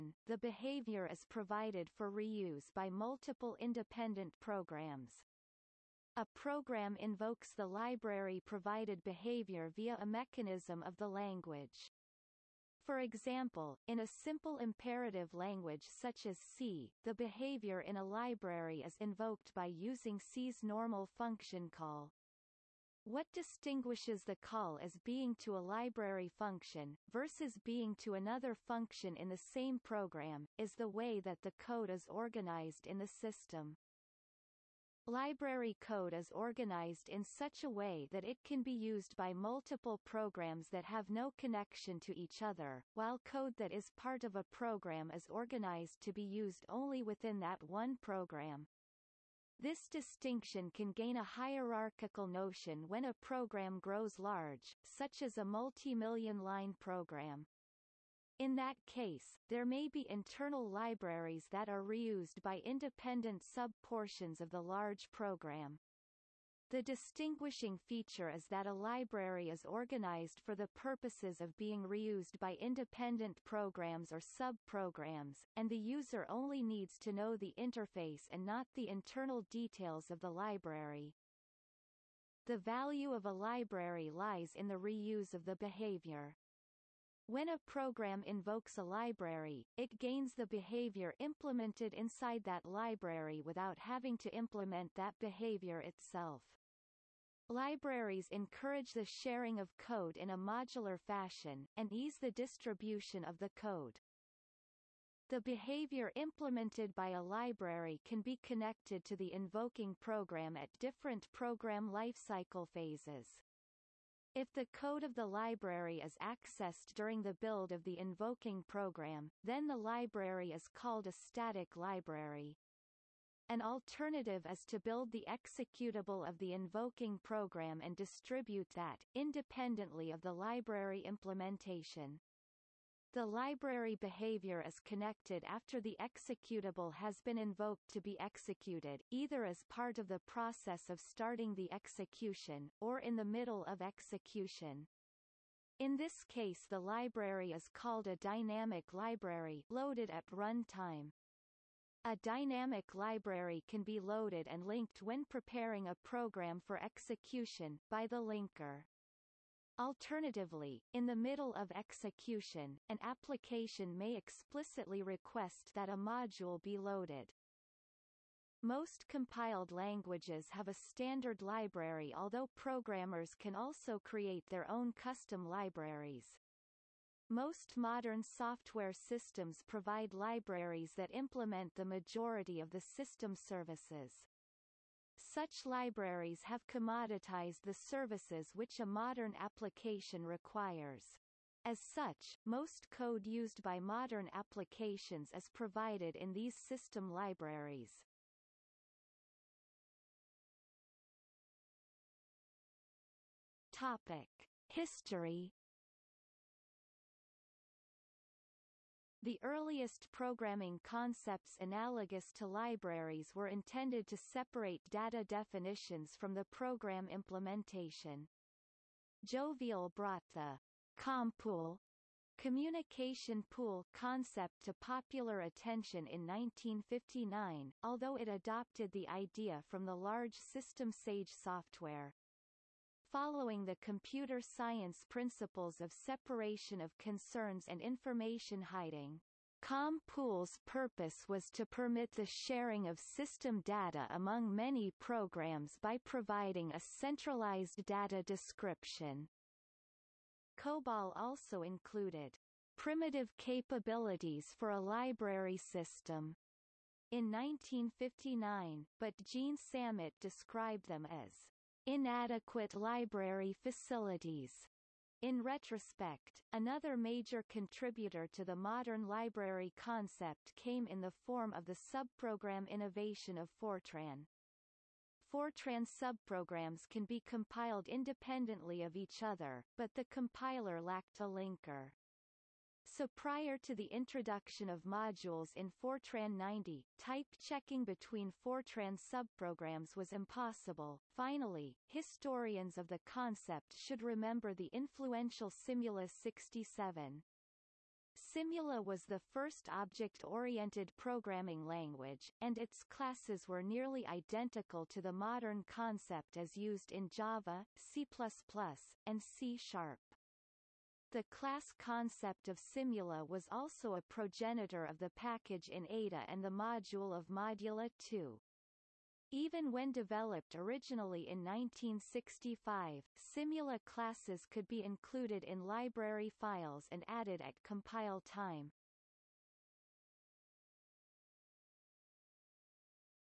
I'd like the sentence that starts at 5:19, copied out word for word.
Even when developed originally in 1965, simula classes could be included in library files and added at compile time.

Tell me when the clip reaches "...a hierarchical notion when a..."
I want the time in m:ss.
0:51.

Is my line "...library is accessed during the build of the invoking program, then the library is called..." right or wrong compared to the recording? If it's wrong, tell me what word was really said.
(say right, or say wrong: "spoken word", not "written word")
right.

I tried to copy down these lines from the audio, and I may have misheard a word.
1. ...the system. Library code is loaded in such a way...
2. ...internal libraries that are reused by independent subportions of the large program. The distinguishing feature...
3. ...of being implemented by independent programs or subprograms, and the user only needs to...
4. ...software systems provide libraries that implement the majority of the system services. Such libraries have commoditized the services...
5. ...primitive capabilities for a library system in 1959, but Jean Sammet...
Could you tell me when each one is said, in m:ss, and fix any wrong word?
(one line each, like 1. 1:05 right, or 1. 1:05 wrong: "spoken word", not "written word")
1. 0:32 wrong: "organized", not "loaded"
2. 1:00 right
3. 1:11 wrong: "reused", not "implemented"
4. 2:58 right
5. 4:12 right.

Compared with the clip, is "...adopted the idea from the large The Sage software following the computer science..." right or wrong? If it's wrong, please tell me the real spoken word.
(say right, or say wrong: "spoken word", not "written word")
wrong: "System", not "The".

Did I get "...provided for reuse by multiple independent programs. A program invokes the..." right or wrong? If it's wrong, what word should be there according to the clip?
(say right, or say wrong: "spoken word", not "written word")
right.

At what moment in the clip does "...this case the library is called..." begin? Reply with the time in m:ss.
2:25.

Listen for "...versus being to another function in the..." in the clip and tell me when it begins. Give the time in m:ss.
0:27.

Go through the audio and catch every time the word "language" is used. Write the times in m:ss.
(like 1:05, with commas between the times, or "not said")
0:11, 0:15, 2:49, 5:01.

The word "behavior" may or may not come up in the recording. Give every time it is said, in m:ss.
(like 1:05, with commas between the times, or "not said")
0:00, 0:09, 0:17, 1:25, 1:30, 1:35, 1:45, 2:13.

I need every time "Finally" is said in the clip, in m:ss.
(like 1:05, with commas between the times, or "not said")
4:51.